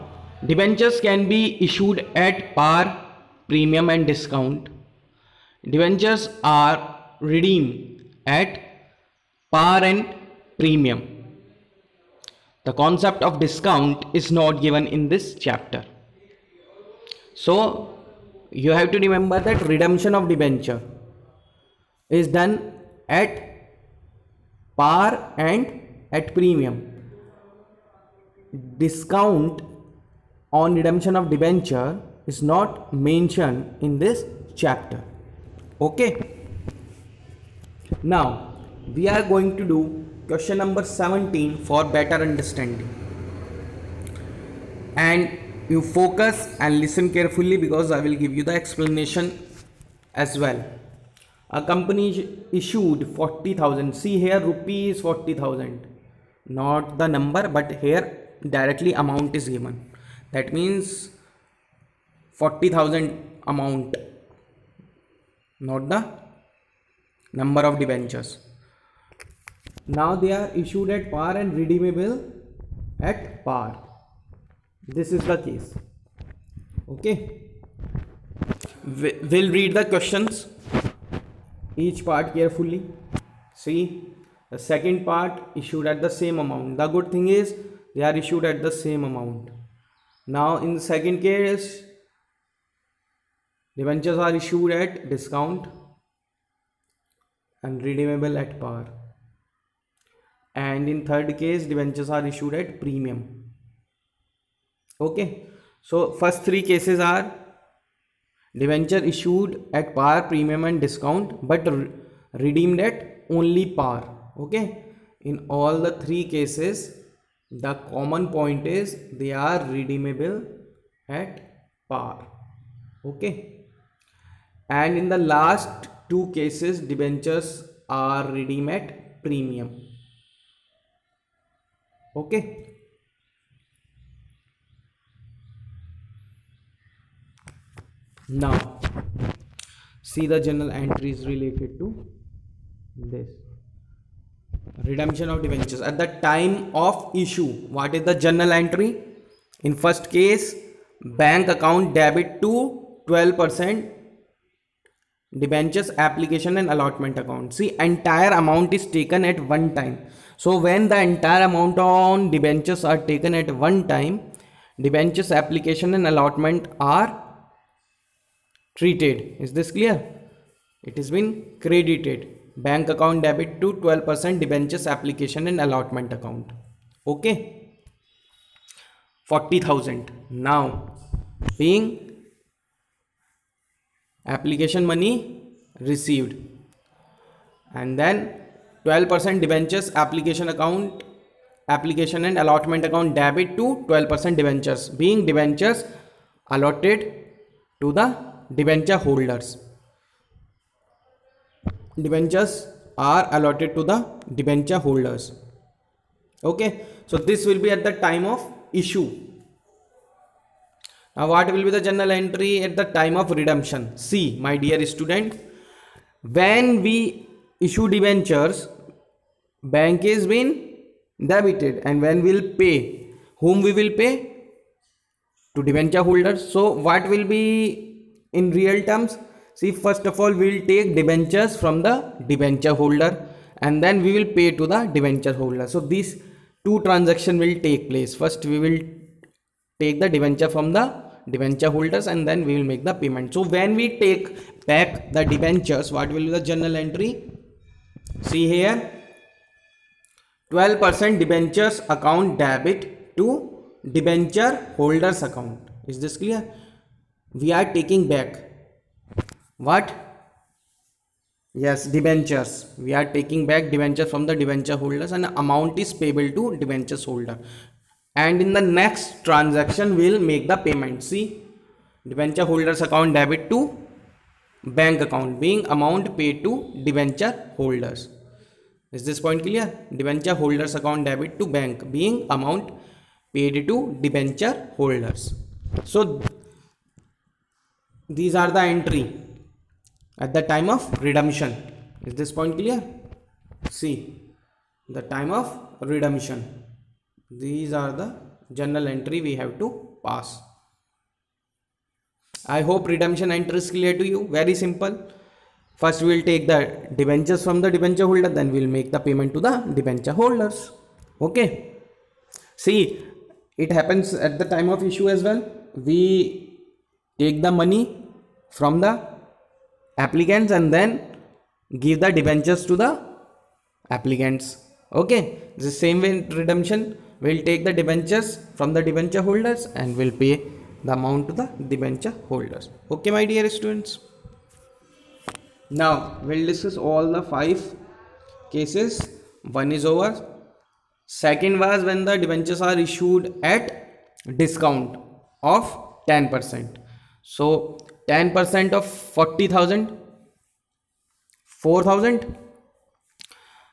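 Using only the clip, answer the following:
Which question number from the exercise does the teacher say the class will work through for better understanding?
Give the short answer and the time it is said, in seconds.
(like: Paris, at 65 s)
17, at 40 s.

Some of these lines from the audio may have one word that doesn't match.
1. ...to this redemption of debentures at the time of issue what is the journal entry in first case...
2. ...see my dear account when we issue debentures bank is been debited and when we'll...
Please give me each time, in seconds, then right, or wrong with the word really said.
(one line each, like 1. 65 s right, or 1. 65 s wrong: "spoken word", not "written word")
1. 141 s right
2. 213 s wrong: "student", not "account".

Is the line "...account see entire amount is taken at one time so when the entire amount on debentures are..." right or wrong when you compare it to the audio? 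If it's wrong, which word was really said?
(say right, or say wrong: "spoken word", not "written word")
right.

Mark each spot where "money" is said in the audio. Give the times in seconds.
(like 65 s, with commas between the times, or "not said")
317 s.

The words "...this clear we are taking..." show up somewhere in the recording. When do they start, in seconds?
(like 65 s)
255 s.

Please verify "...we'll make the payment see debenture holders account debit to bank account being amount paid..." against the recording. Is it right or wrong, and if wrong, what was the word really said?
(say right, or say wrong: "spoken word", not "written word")
right.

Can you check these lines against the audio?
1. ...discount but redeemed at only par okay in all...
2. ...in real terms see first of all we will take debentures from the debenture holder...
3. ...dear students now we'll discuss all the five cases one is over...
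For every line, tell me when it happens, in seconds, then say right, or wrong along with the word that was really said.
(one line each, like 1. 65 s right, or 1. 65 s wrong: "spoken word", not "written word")
1. 110 s right
2. 228 s right
3. 333 s right.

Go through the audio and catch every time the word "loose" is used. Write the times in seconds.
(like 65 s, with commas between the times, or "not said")
not said.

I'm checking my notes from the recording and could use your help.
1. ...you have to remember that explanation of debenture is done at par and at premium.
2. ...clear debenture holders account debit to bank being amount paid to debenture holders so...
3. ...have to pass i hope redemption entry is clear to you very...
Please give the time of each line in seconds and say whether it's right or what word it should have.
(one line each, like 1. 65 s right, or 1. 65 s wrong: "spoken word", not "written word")
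1. 18 s wrong: "redemption", not "explanation"
2. 279 s right
3. 299 s right.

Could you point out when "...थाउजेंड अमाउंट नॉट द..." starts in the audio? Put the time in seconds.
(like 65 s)
62 s.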